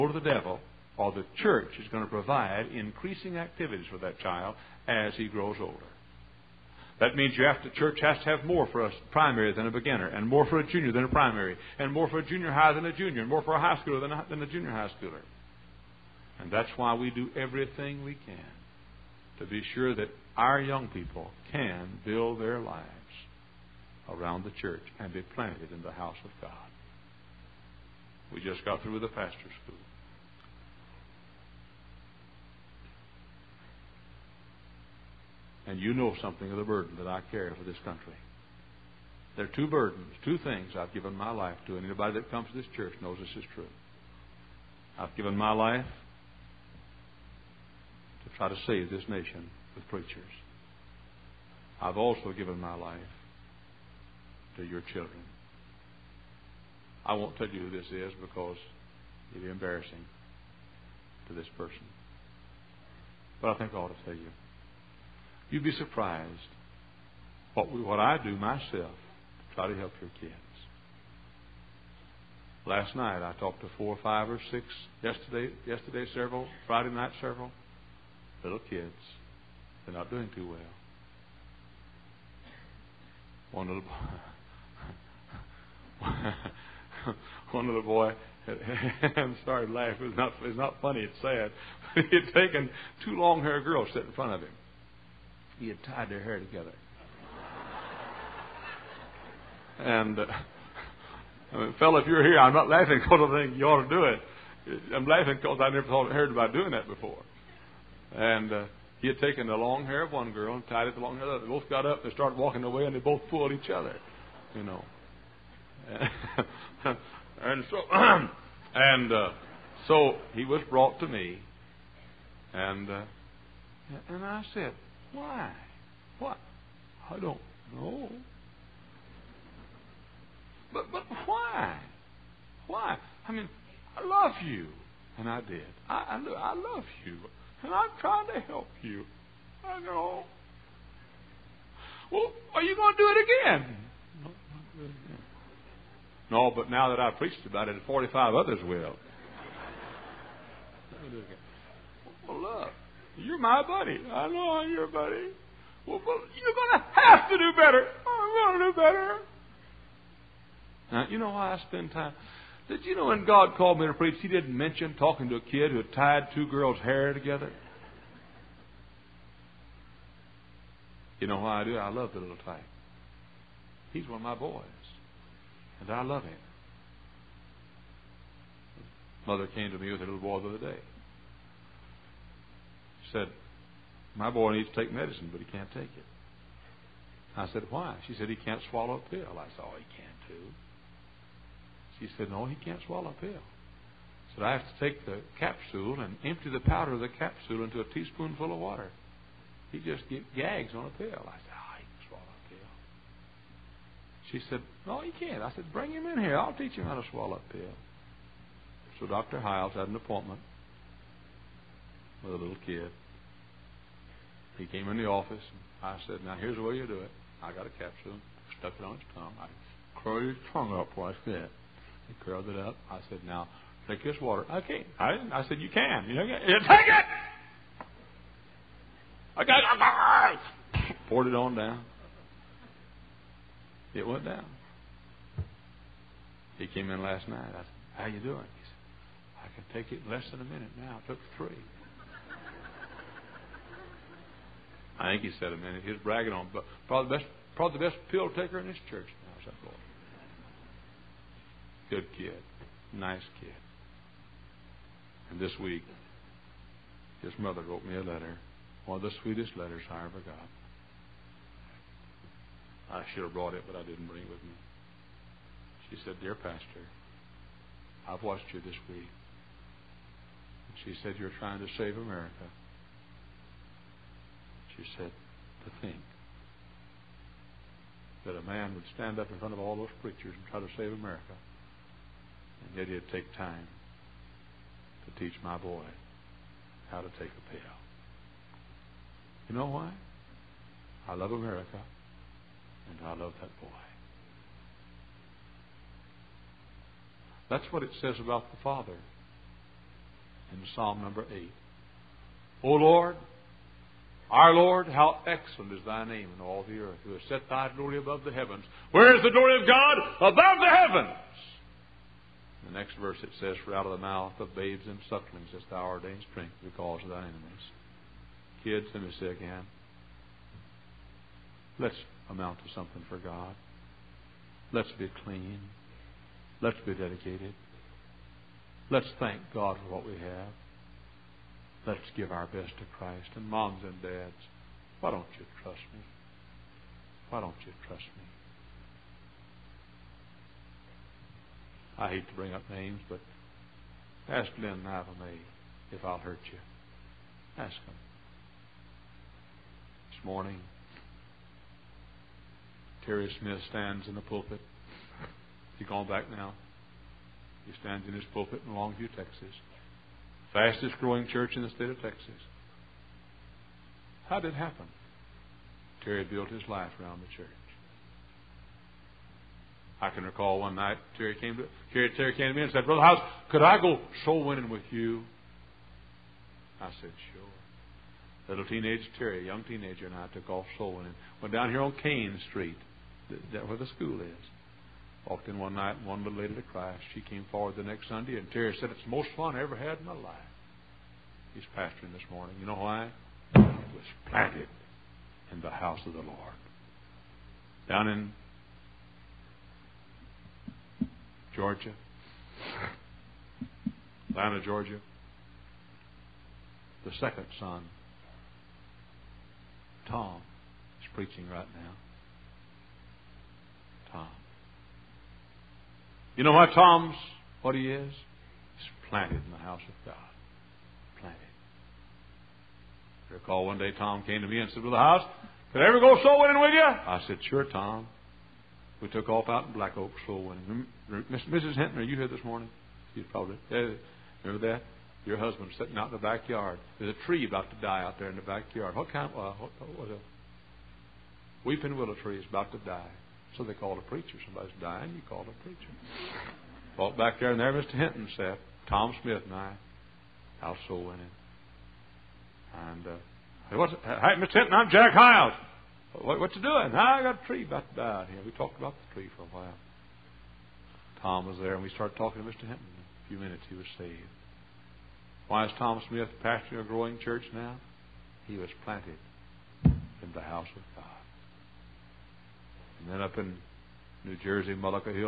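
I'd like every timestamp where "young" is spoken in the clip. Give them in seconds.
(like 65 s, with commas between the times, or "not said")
20 s, 379 s.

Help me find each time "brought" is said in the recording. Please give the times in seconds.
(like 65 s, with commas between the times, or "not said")
120 s, 263 s.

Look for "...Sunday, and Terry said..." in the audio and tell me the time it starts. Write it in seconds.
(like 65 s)
388 s.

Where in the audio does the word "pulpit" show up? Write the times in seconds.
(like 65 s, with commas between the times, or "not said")
354 s, 358 s.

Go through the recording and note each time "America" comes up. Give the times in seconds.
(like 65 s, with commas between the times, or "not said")
271 s, 280 s, 291 s.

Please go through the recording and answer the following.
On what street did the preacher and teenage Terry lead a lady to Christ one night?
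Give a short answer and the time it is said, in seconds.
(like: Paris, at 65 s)
Kane Street, at 382 s.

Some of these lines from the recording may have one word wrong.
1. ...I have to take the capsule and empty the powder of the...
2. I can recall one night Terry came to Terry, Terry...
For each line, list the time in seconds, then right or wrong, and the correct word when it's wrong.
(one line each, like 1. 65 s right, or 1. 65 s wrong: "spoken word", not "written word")
1. 194 s right
2. 370 s right.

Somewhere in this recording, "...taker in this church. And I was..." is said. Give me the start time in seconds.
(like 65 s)
248 s.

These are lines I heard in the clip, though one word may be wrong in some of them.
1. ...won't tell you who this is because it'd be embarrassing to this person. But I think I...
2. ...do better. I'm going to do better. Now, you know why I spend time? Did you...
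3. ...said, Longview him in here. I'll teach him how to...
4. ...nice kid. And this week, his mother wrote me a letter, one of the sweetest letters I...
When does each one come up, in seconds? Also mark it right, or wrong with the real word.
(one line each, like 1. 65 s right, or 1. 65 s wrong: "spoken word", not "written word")
1. 57 s right
2. 157 s right
3. 205 s wrong: "Bring", not "Longview"
4. 252 s right.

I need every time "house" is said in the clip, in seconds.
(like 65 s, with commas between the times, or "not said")
25 s, 395 s, 419 s, 424 s, 450 s, 470 s.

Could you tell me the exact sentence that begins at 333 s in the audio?
And moms and dads, why don't you trust me?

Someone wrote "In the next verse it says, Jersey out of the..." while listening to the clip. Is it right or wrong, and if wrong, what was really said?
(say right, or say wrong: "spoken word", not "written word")
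wrong: "For", not "Jersey".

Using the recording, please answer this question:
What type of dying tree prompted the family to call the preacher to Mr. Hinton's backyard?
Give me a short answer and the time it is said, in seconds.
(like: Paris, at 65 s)
Weeping willow, at 441 s.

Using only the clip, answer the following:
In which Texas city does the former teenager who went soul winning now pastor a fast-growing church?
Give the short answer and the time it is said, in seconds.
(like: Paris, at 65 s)
Longview, at 358 s.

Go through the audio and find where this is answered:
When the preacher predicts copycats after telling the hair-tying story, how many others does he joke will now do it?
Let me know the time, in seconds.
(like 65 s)
147 s.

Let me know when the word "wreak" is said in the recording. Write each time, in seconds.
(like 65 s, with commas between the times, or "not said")
not said.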